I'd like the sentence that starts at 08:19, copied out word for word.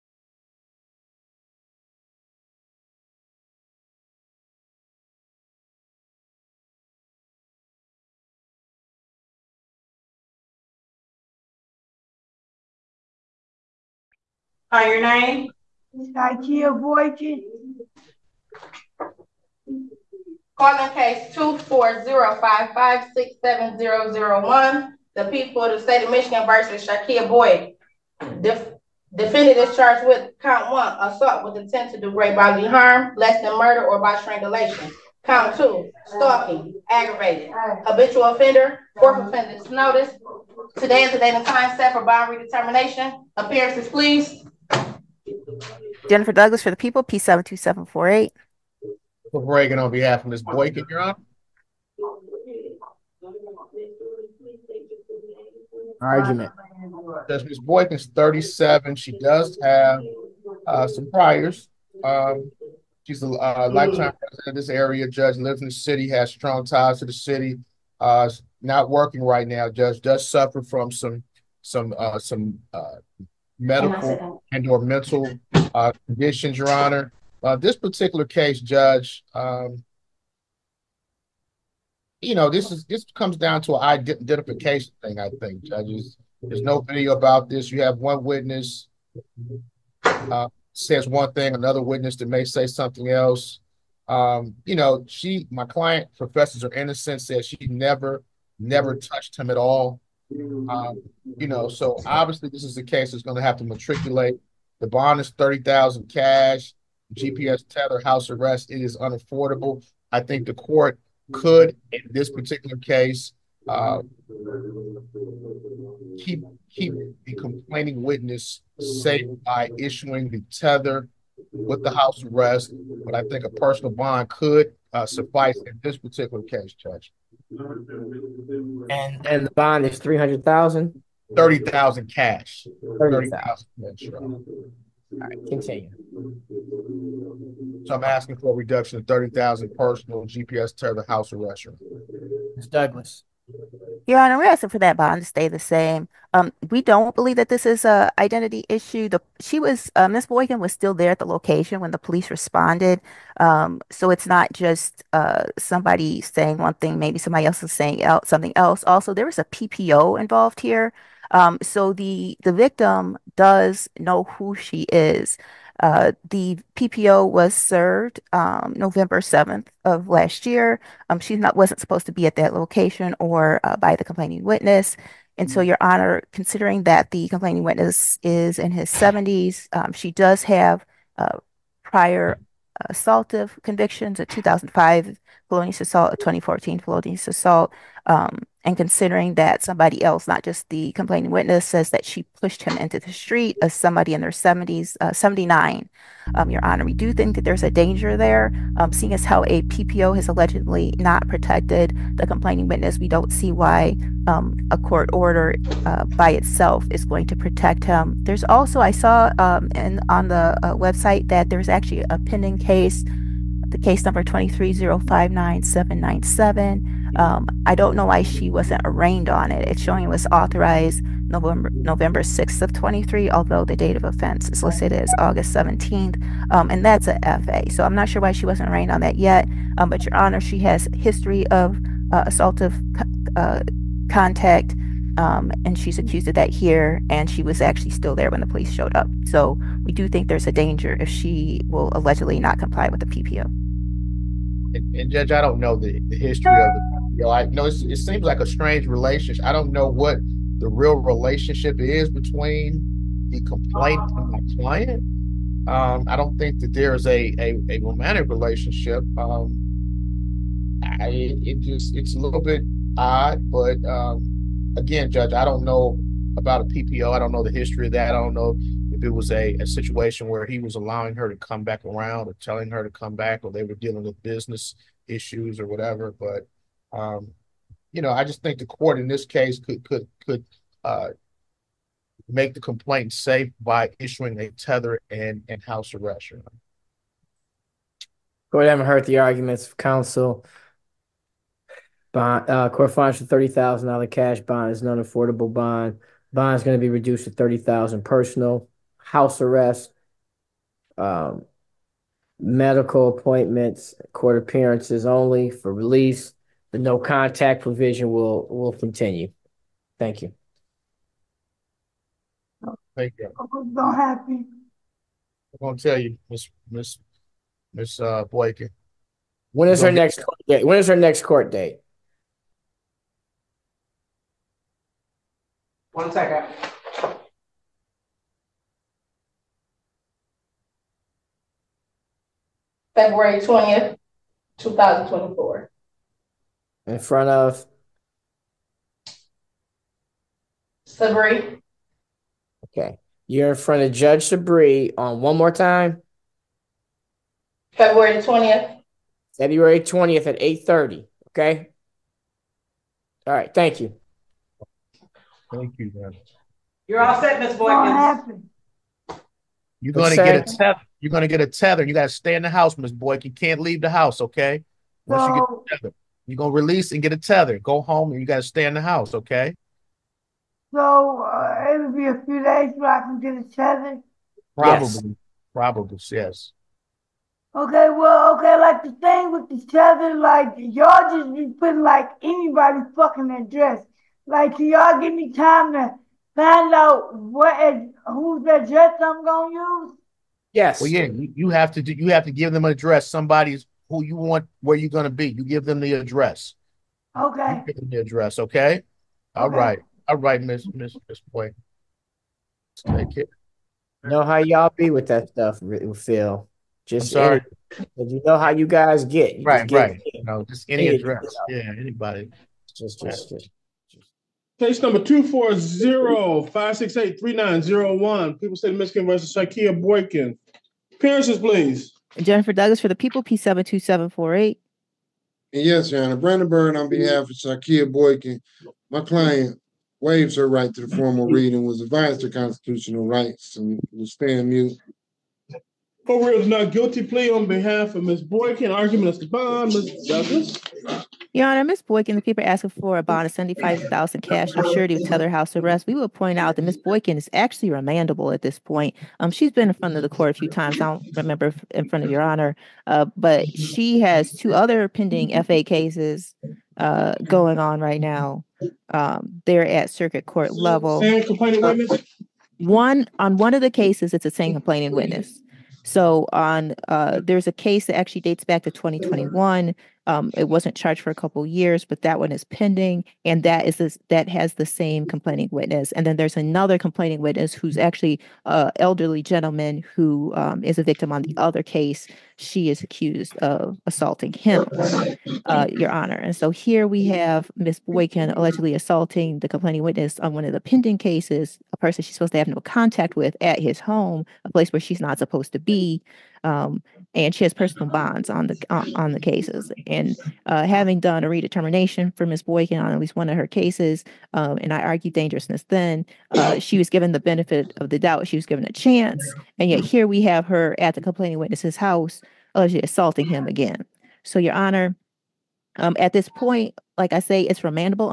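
And uh, having done a redetermination for Ms.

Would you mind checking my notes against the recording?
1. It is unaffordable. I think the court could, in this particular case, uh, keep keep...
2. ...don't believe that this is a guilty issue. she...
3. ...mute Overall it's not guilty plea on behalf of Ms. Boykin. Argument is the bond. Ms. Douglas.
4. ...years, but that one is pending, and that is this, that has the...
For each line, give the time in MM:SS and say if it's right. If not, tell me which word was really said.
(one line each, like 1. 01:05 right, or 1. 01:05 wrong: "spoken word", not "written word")
1. 01:48 right
2. 02:26 wrong: "identity", not "guilty"
3. 07:14 right
4. 07:51 right.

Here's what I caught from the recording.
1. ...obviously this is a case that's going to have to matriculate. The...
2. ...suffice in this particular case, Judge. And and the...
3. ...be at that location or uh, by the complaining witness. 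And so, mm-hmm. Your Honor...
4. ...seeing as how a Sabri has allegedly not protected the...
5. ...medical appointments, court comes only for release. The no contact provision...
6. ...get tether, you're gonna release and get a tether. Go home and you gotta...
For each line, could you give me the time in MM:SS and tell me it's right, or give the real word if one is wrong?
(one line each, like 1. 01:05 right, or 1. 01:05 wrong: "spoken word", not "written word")
1. 01:42 right
2. 02:05 right
3. 02:52 right
4. 03:18 wrong: "PPO", not "Sabri"
5. 05:02 wrong: "appearances", not "comes"
6. 06:05 right.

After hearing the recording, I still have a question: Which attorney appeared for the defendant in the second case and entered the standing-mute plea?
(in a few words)
Brandon Bird.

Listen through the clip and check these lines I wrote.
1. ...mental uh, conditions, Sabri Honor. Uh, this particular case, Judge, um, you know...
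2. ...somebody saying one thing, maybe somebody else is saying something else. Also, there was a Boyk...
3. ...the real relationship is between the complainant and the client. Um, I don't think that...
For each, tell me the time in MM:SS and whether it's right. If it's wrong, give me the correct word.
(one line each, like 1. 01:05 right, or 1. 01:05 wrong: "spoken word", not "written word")
1. 01:14 wrong: "Your", not "Sabri"
2. 02:35 wrong: "PPO", not "Boyk"
3. 04:10 right.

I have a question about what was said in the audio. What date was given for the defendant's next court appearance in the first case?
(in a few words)
February 20th, 2024.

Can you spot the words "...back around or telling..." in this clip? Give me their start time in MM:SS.
04:31.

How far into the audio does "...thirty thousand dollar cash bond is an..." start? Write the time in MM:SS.
04:53.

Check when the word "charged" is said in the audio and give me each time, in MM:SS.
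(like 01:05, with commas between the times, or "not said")
00:29, 07:50.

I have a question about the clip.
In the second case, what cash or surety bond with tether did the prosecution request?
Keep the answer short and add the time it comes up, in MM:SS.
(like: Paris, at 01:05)
$75,000, at 07:23.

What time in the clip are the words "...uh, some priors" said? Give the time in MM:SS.
01:00.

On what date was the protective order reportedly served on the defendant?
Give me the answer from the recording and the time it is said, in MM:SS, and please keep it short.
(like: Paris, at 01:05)
November 7th, at 02:48.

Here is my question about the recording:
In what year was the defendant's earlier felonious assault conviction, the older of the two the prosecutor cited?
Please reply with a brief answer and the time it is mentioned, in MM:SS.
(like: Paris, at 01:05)
2005, at 03:04.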